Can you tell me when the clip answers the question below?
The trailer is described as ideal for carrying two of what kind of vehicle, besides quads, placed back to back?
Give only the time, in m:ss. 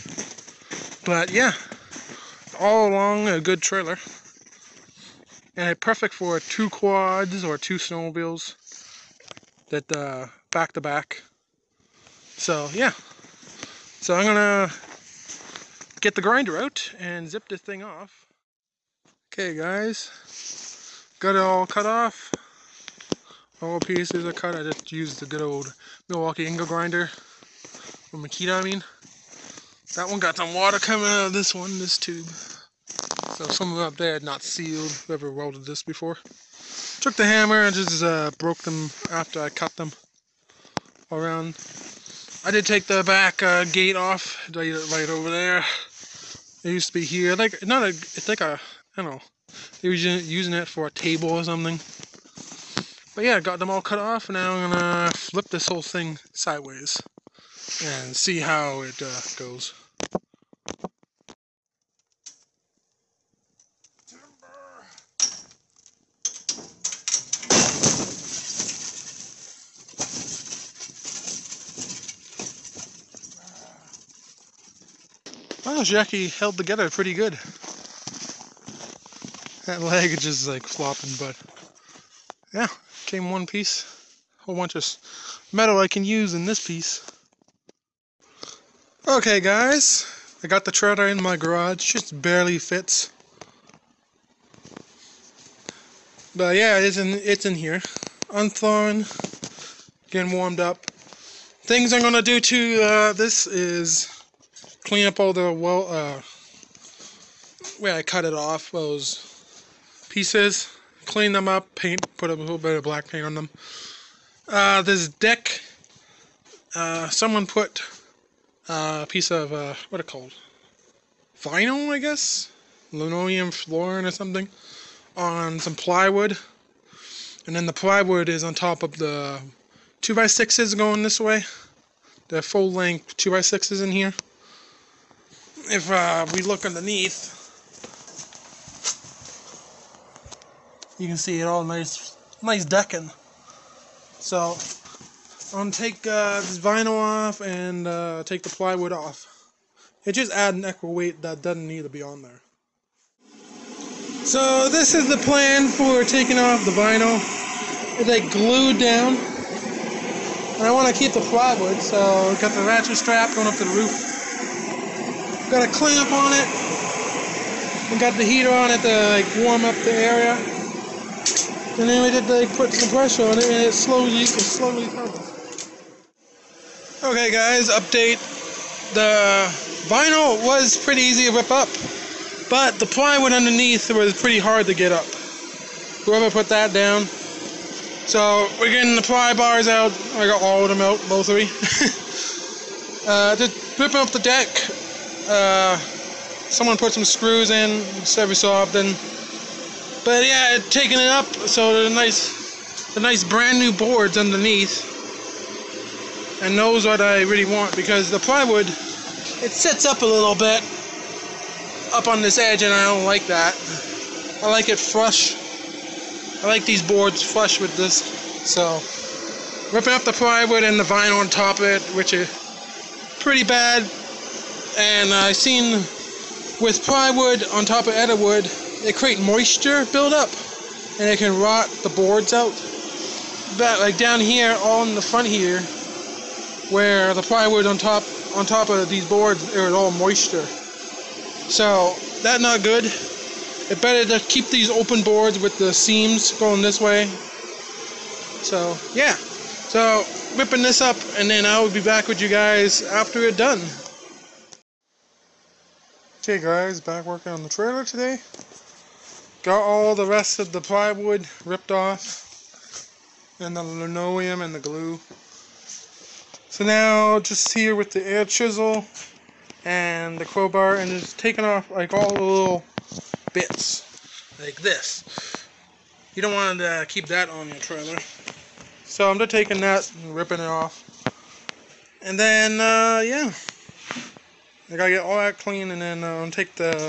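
0:07.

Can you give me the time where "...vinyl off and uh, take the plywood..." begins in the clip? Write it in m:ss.
2:26.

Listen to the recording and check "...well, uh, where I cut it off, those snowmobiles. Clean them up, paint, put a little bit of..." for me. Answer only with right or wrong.
wrong.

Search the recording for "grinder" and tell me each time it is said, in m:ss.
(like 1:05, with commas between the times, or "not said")
0:16, 0:26.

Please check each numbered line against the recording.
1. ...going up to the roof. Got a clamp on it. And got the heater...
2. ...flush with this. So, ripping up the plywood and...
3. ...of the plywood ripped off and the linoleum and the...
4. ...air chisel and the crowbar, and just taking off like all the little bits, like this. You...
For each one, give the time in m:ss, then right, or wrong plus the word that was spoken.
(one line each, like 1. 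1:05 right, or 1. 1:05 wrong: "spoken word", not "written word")
1. 2:43 right
2. 3:37 right
3. 4:20 right
4. 4:28 right.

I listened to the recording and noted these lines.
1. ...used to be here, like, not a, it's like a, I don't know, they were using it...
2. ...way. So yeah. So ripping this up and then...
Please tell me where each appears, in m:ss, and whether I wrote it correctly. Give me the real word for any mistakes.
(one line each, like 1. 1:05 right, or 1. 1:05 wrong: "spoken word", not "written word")
1. 0:46 right
2. 4:06 right.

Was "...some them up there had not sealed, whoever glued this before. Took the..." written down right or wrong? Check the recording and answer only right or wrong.
wrong.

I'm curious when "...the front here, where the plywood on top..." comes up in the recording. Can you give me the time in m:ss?
3:54.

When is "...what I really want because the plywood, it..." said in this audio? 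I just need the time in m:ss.
3:26.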